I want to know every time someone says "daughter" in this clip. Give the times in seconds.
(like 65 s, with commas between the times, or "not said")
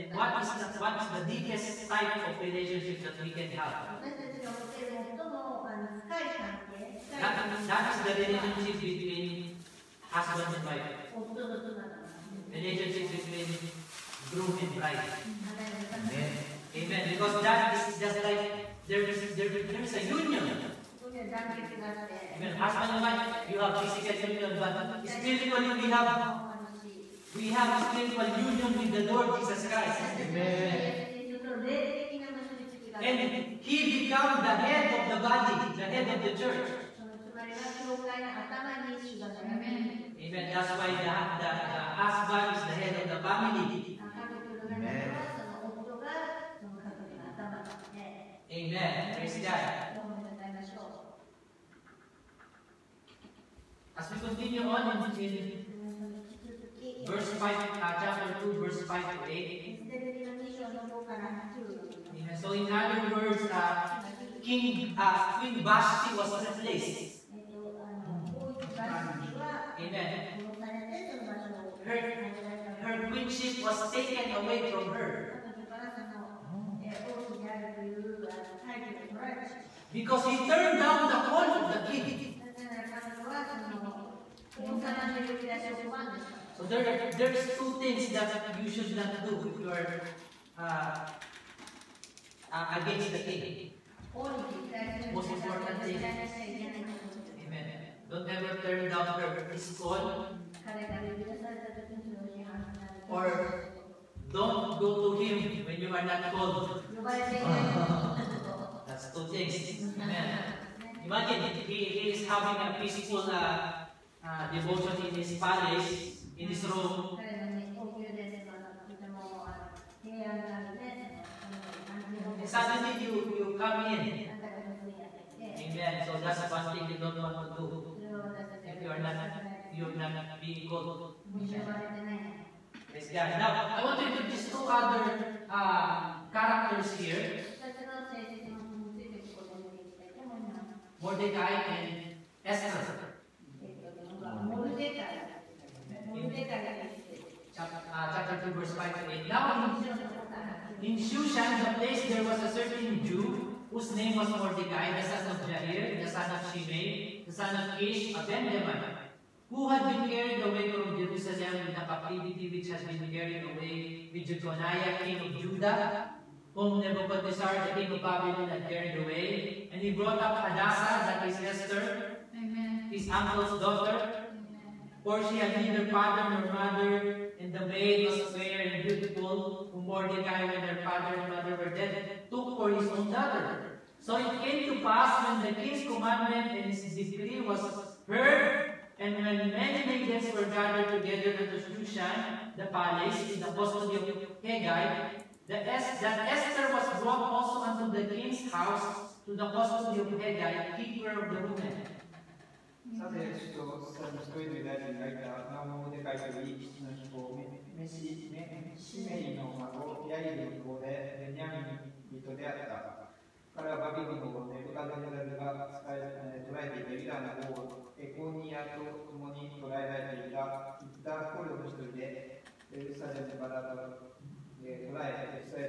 173 s, 183 s.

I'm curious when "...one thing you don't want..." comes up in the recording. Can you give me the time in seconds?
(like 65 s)
126 s.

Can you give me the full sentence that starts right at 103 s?
Or don't go to him when you are not called.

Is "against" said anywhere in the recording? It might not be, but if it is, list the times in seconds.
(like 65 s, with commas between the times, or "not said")
92 s.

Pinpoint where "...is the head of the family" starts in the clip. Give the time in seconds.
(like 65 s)
42 s.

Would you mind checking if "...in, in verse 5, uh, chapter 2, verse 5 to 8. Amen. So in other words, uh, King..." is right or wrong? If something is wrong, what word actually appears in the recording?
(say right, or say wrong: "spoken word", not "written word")
right.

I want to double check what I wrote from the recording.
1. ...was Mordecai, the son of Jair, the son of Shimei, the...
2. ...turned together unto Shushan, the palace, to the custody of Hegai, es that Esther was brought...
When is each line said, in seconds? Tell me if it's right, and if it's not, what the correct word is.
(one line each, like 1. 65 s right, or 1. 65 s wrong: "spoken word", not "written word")
1. 154 s right
2. 190 s wrong: "gathered", not "turned".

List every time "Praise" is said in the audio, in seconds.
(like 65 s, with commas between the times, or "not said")
49 s, 132 s.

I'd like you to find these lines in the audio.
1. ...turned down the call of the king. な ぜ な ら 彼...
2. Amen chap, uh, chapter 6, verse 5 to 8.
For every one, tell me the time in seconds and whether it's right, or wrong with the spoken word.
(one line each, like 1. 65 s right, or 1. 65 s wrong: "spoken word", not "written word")
1. 80 s right
2. 144 s wrong: "2", not "6".